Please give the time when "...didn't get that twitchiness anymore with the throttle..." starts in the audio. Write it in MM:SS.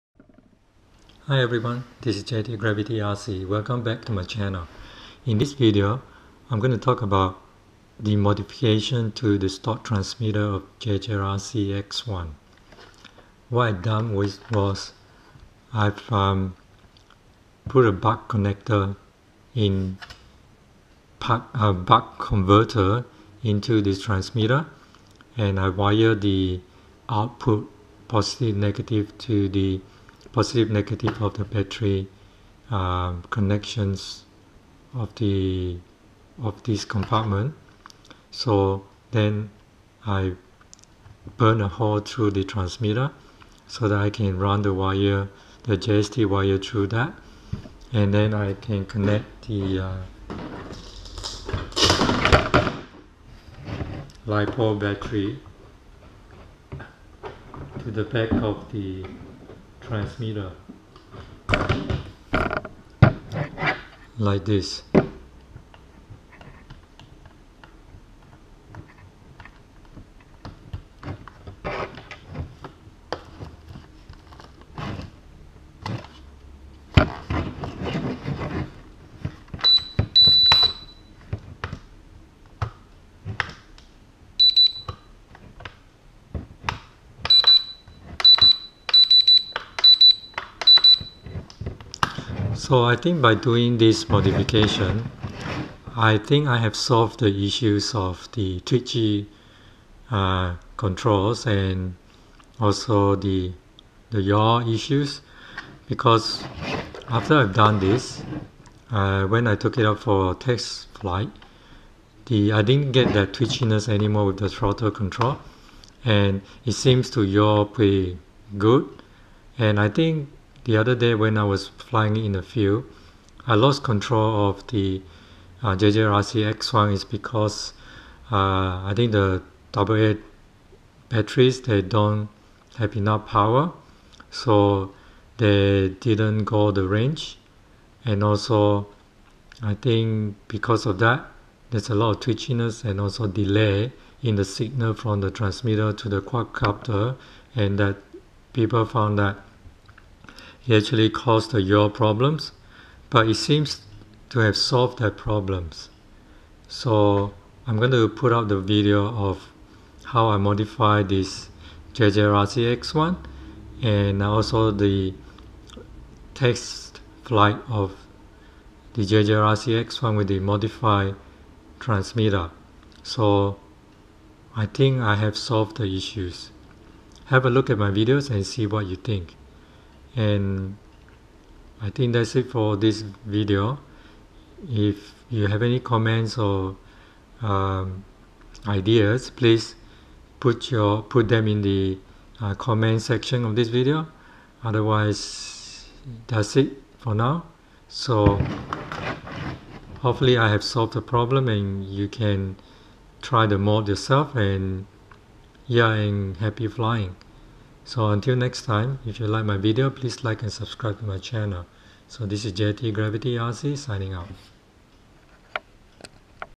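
01:52.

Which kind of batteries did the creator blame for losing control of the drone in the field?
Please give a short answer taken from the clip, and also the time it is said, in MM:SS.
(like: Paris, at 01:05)
AA batteries, at 02:09.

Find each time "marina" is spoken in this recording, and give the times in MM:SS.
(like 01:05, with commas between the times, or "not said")
not said.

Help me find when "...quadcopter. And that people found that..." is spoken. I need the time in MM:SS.
02:26.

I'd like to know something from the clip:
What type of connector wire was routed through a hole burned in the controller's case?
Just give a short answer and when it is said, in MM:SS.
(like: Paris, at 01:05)
JST, at 00:45.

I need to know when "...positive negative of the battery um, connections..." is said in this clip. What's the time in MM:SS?
00:30.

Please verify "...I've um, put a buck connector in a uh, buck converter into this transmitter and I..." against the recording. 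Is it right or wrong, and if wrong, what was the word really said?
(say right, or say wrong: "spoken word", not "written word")
right.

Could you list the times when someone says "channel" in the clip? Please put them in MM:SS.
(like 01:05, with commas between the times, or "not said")
00:04, 03:31.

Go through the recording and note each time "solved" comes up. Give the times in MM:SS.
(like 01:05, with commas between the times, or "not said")
01:36, 02:34, 02:55, 03:20.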